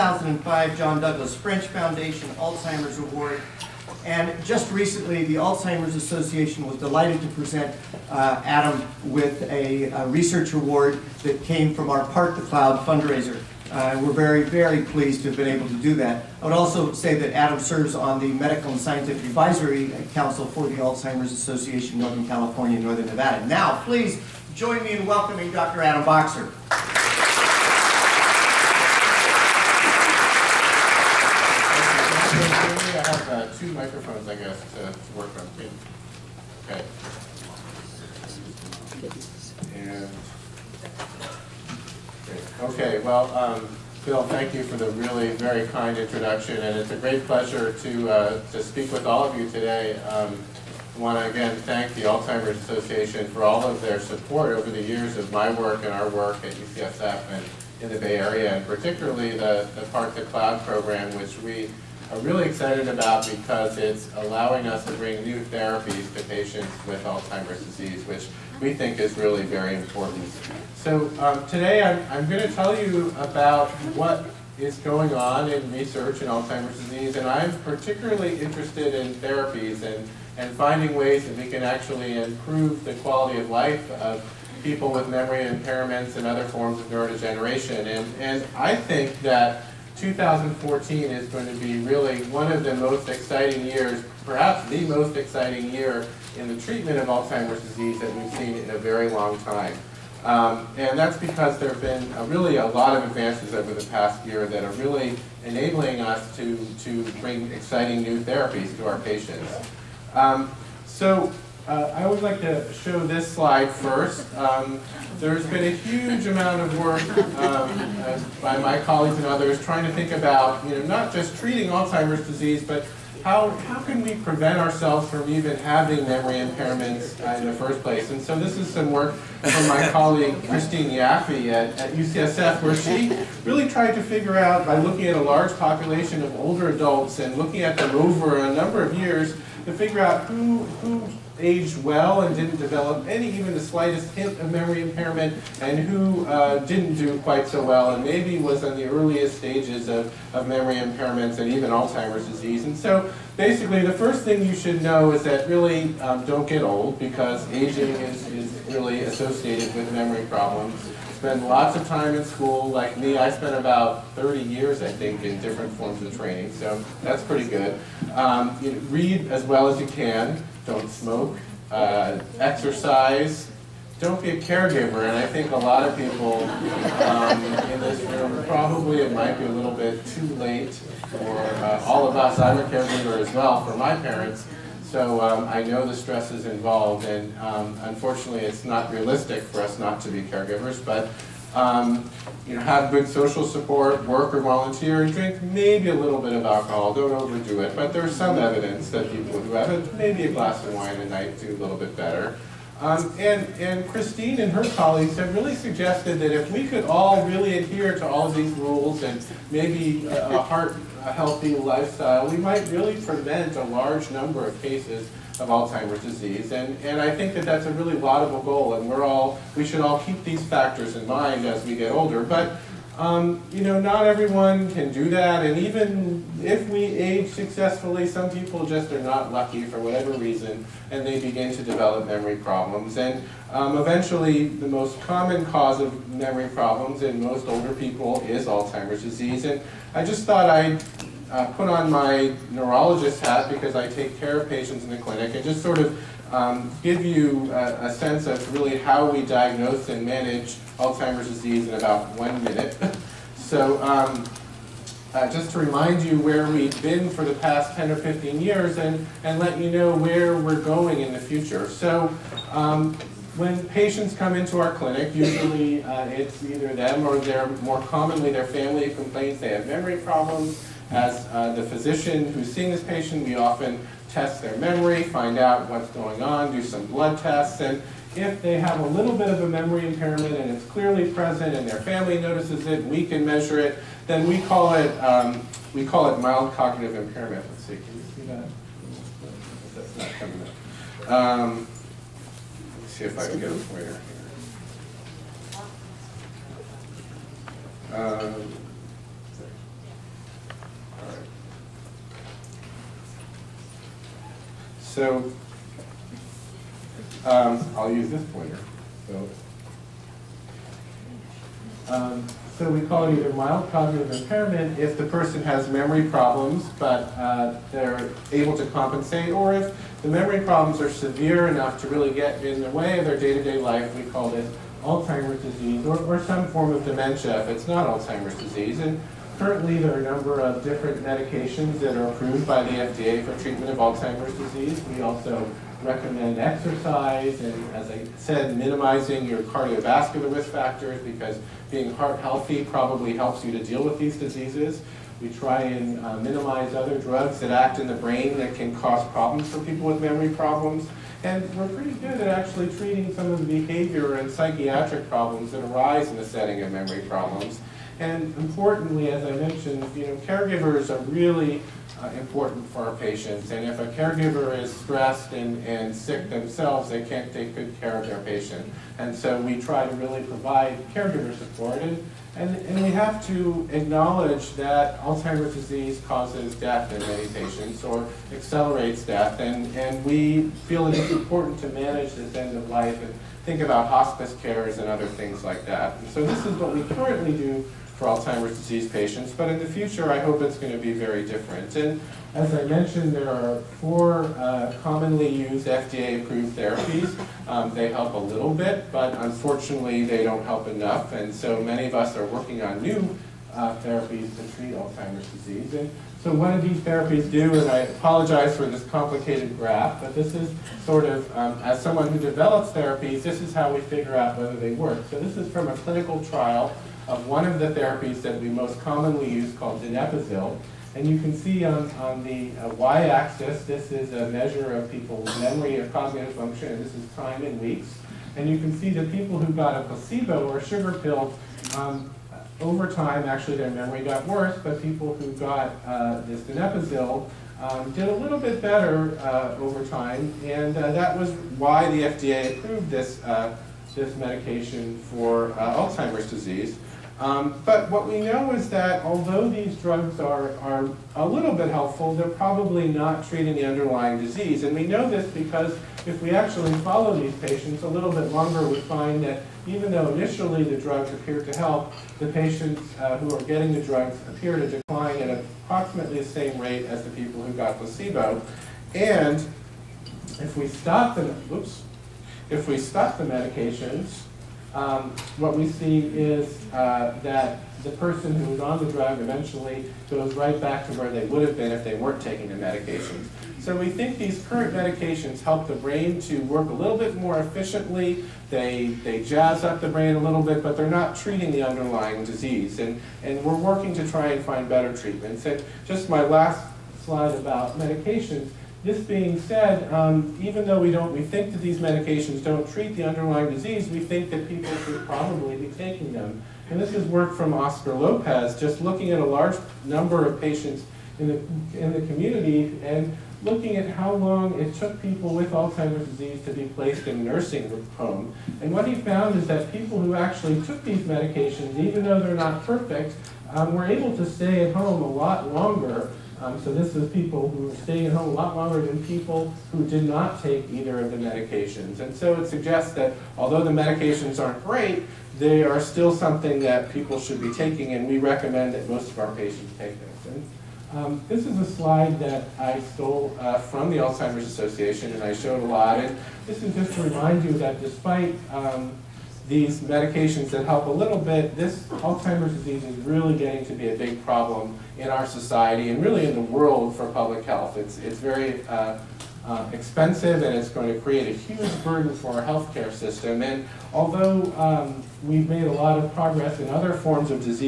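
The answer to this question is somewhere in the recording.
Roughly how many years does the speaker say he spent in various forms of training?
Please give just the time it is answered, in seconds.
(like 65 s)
164 s.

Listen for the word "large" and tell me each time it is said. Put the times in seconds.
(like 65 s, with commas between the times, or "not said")
135 s, 213 s, 509 s.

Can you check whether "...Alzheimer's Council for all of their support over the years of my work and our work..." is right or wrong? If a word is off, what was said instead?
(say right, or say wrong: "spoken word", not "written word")
wrong: "Association", not "Council".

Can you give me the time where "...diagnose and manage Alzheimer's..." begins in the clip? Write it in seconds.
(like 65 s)
249 s.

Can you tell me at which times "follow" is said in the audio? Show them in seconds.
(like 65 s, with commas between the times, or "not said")
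456 s.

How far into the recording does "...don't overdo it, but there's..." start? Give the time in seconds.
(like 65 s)
196 s.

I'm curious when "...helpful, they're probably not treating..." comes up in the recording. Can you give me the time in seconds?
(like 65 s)
451 s.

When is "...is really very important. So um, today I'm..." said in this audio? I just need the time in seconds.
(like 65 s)
68 s.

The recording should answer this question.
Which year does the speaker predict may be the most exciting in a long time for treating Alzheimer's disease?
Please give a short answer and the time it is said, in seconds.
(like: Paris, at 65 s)
2014, at 89 s.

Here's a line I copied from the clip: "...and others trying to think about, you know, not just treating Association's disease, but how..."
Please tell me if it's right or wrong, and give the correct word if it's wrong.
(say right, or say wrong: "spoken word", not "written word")
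wrong: "Alzheimer", not "Association".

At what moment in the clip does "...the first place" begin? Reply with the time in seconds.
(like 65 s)
127 s.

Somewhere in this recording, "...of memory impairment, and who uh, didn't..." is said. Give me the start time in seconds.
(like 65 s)
144 s.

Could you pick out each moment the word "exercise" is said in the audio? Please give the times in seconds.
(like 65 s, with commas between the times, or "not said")
172 s, 336 s.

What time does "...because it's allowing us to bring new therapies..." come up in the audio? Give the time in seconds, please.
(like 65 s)
63 s.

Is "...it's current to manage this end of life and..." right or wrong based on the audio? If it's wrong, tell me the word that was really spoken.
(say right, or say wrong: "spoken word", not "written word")
wrong: "important", not "current".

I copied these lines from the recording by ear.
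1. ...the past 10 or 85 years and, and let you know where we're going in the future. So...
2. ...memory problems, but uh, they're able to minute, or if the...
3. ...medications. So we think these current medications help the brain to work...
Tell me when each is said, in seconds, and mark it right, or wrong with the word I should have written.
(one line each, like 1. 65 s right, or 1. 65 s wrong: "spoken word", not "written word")
1. 257 s wrong: "15", not "85"
2. 315 s wrong: "compensate", not "minute"
3. 482 s right.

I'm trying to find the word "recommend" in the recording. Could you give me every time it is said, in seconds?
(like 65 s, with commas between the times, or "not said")
335 s, 538 s.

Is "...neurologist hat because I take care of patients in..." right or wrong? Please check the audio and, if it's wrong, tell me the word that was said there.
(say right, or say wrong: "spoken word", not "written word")
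right.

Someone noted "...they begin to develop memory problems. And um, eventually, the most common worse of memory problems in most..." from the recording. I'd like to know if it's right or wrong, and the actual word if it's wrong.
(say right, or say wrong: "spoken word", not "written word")
wrong: "cause", not "worse".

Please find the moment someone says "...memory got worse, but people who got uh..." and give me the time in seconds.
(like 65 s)
433 s.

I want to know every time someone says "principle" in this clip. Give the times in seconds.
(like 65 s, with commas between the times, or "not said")
not said.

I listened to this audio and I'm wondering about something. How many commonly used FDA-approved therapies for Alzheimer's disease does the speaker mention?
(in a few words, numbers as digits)
4.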